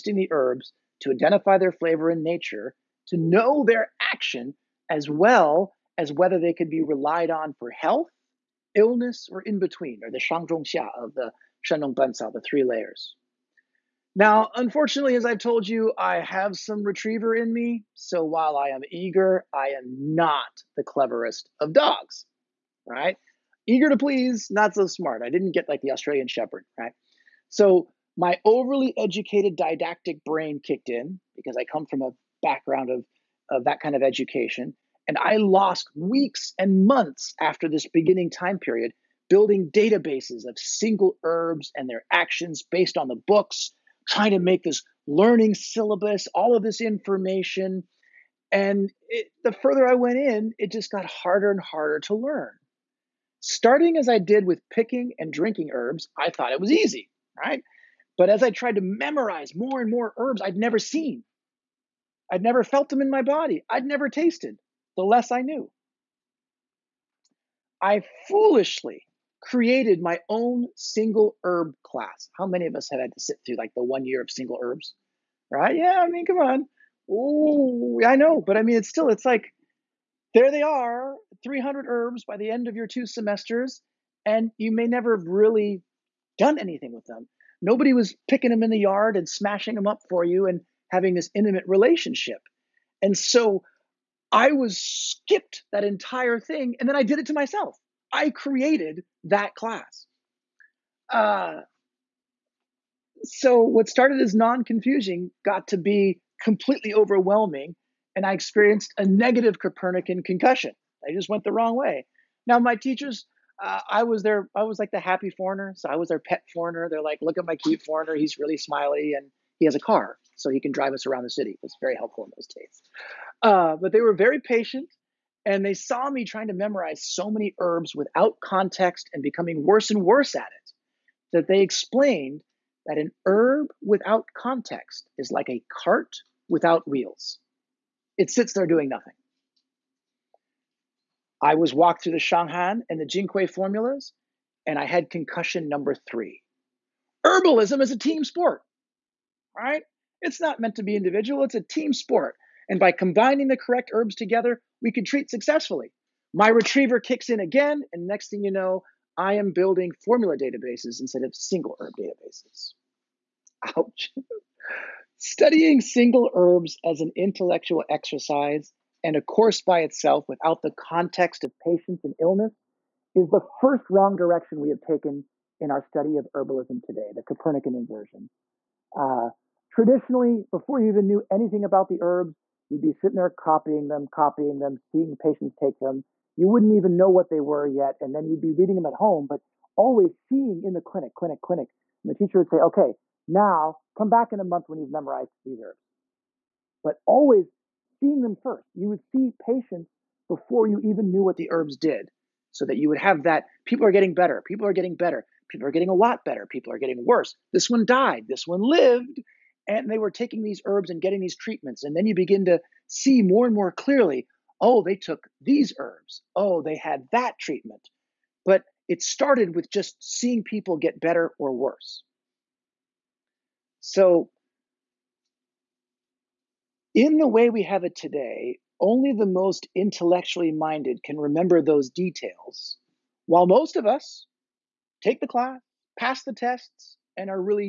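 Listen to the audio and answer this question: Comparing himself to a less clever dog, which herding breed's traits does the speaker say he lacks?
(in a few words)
Australian Shepherd.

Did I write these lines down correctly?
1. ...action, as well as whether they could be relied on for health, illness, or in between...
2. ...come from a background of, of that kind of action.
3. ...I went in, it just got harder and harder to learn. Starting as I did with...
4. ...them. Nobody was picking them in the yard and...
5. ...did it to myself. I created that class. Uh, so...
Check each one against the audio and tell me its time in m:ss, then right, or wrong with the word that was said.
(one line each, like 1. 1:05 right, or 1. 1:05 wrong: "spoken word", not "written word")
1. 0:04 right
2. 0:31 wrong: "education", not "action"
3. 0:49 right
4. 1:27 right
5. 1:37 right.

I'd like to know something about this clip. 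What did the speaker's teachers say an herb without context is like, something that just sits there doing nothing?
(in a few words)
a cart without wheels.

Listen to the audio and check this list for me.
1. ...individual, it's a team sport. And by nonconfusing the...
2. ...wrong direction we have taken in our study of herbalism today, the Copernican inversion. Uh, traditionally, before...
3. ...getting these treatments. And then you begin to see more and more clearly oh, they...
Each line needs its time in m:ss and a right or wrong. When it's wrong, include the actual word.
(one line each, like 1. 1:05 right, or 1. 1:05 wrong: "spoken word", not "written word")
1. 2:30 wrong: "combining", not "nonconfusing"
2. 2:53 right
3. 3:31 right.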